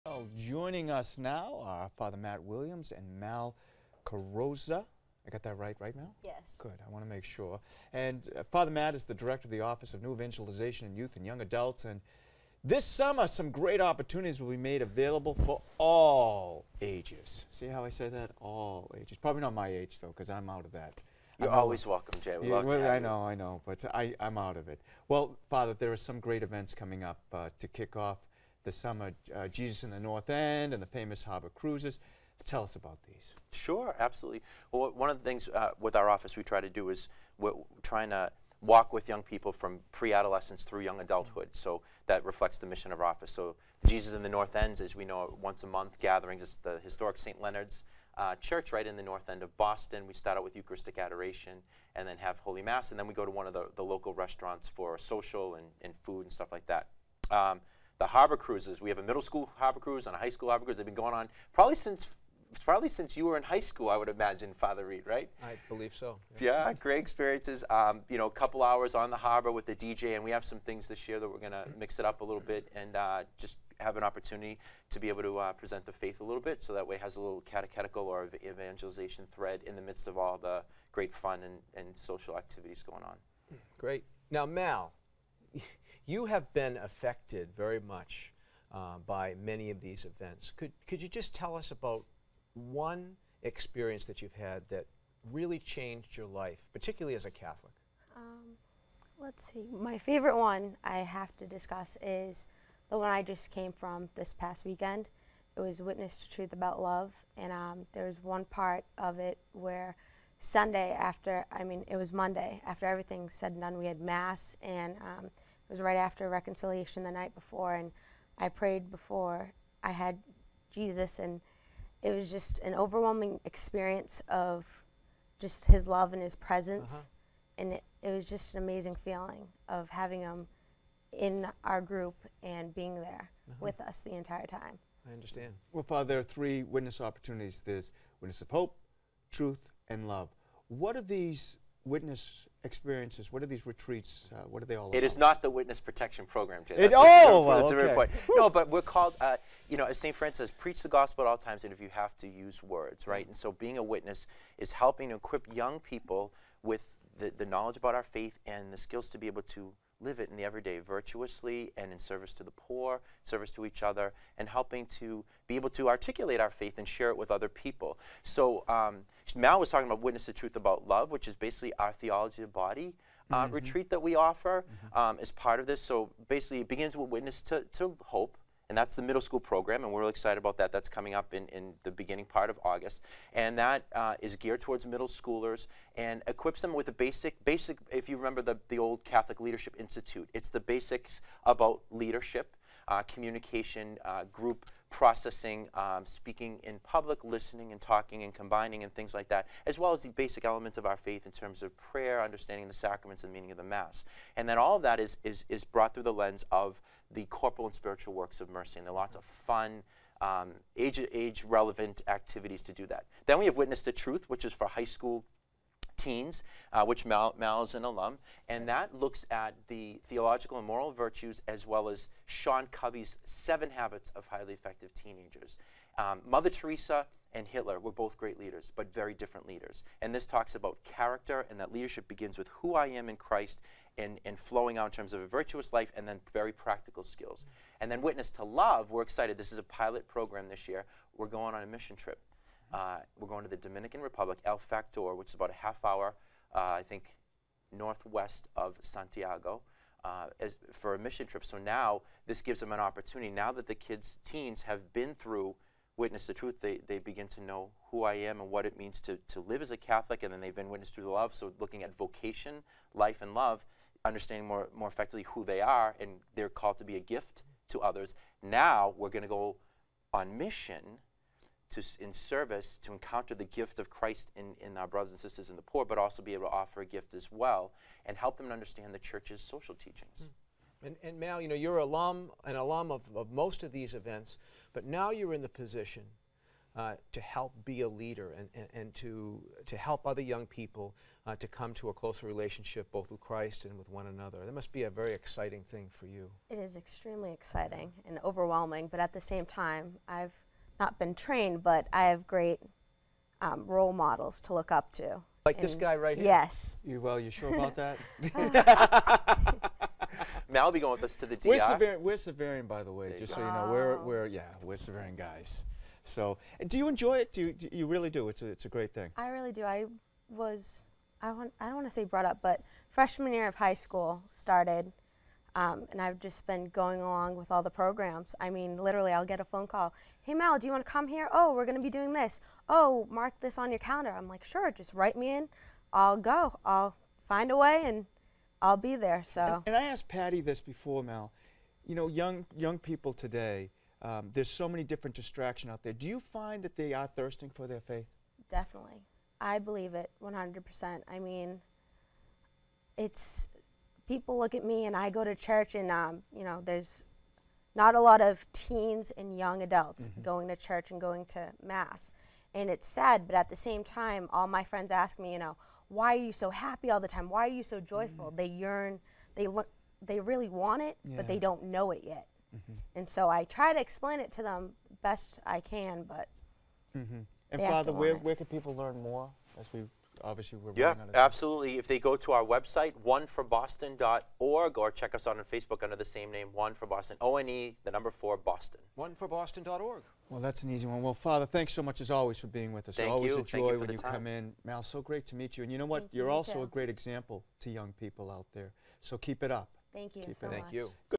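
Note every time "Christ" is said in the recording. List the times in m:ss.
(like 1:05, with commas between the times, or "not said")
3:53, 4:33, 4:53.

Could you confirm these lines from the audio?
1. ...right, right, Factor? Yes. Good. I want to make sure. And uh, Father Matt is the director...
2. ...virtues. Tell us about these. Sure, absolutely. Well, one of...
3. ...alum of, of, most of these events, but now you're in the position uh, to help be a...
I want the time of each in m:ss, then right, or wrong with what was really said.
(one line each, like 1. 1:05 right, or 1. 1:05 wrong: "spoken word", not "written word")
1. 0:05 wrong: "Mal", not "Factor"
2. 0:31 wrong: "cruises", not "virtues"
3. 4:42 right.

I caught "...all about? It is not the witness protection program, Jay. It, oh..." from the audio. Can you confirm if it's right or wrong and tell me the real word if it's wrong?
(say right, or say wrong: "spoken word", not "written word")
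right.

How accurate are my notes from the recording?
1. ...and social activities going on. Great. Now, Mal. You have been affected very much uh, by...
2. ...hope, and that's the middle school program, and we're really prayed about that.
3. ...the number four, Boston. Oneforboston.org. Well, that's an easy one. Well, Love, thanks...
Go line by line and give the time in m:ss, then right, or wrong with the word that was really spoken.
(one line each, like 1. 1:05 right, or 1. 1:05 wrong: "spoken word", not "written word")
1. 1:21 right
2. 2:58 wrong: "excited", not "prayed"
3. 6:27 wrong: "Father", not "Love".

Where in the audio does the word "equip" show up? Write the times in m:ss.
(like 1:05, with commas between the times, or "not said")
2:35, 3:06.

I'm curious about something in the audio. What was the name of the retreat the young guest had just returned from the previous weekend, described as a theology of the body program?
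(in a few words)
Witness to Truth About Love.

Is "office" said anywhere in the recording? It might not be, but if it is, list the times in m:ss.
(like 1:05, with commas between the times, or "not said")
0:09, 0:36, 0:43.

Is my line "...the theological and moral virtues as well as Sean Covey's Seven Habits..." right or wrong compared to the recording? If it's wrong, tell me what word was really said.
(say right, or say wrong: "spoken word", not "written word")
right.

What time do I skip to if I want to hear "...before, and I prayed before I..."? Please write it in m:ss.
1:57.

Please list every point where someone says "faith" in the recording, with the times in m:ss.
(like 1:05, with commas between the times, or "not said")
1:15, 2:38, 2:46, 3:20, 5:47.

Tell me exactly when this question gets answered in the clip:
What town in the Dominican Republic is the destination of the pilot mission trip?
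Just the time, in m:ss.
4:04.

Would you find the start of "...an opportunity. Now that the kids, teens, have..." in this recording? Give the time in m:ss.
4:12.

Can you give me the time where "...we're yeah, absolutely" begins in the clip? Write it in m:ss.
6:20.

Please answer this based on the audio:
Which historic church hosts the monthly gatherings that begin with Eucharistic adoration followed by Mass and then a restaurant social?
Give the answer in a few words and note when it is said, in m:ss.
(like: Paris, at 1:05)
St. Leonard's, at 0:47.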